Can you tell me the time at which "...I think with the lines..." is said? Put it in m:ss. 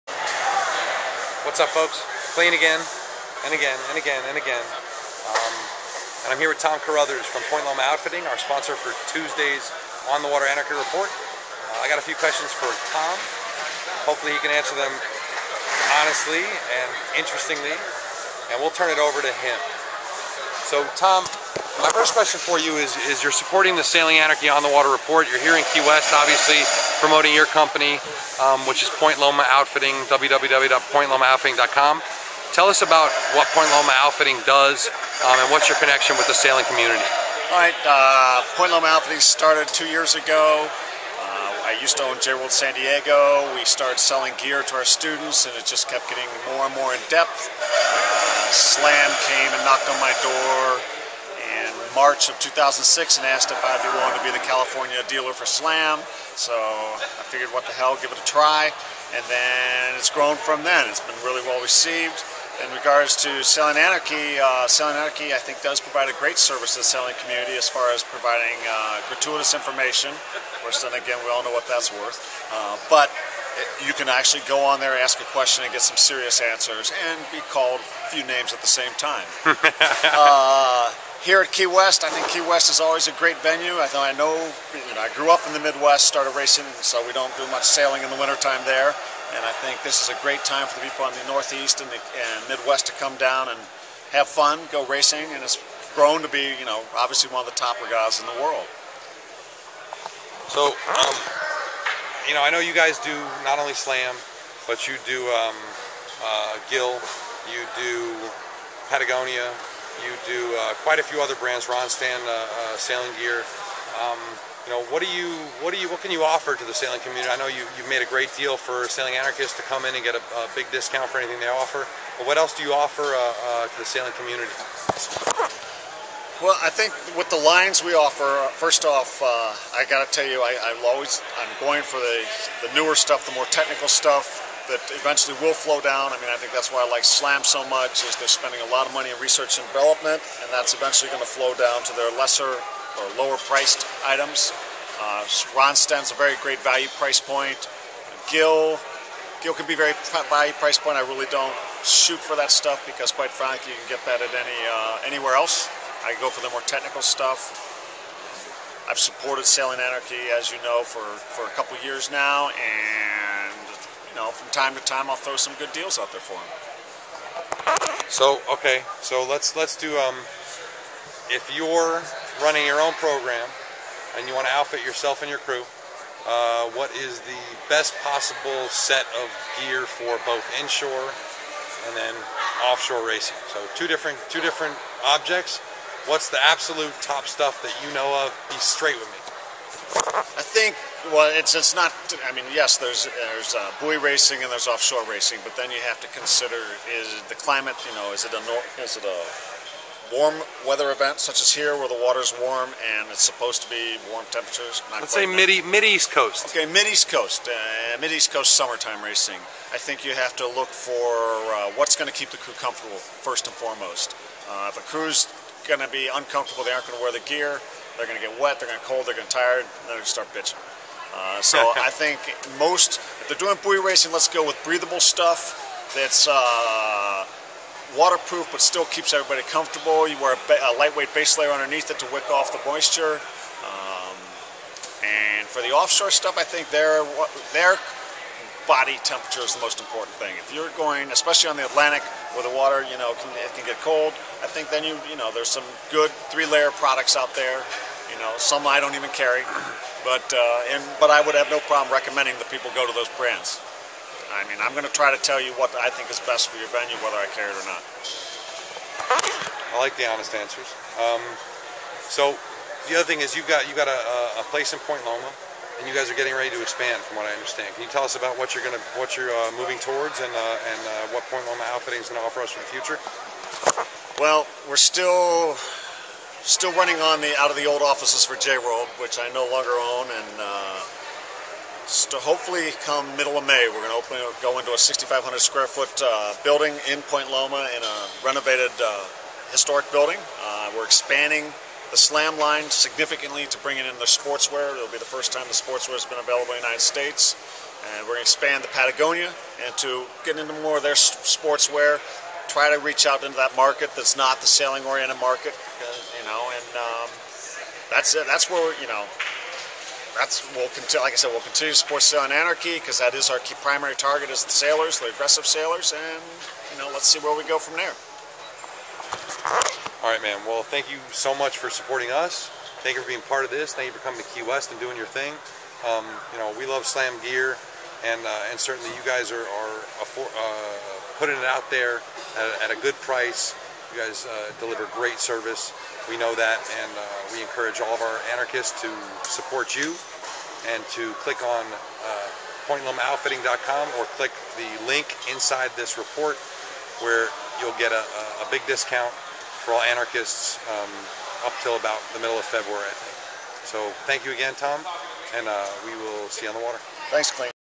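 2:06.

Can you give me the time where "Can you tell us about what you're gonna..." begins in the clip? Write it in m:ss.
4:27.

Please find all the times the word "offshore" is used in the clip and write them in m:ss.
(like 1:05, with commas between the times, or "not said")
3:02, 3:14, 3:55.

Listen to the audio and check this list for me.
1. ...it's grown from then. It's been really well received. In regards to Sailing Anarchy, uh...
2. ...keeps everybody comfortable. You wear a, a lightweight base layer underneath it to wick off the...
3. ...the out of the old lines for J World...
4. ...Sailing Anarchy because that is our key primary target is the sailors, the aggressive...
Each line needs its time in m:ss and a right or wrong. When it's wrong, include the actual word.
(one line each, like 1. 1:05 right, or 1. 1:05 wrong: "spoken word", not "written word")
1. 0:59 right
2. 3:48 right
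3. 4:37 wrong: "offices", not "lines"
4. 5:12 right.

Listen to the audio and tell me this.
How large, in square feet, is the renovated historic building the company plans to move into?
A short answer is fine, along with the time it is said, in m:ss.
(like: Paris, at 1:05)
6,500 square feet, at 4:44.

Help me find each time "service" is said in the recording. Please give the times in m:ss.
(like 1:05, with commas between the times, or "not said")
1:06, 5:35.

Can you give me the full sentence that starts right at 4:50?
Uh, we're expanding the slam line significantly to bring in the sportswear.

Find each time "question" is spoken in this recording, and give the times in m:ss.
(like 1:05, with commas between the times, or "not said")
0:12, 0:22, 1:15.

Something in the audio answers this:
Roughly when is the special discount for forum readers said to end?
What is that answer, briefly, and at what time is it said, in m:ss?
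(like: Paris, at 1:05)
middle of February, at 5:52.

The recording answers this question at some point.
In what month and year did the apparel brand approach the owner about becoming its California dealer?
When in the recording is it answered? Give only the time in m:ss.
0:51.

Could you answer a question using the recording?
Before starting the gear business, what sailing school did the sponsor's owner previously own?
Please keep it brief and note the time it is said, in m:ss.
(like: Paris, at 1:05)
J World San Diego, at 0:42.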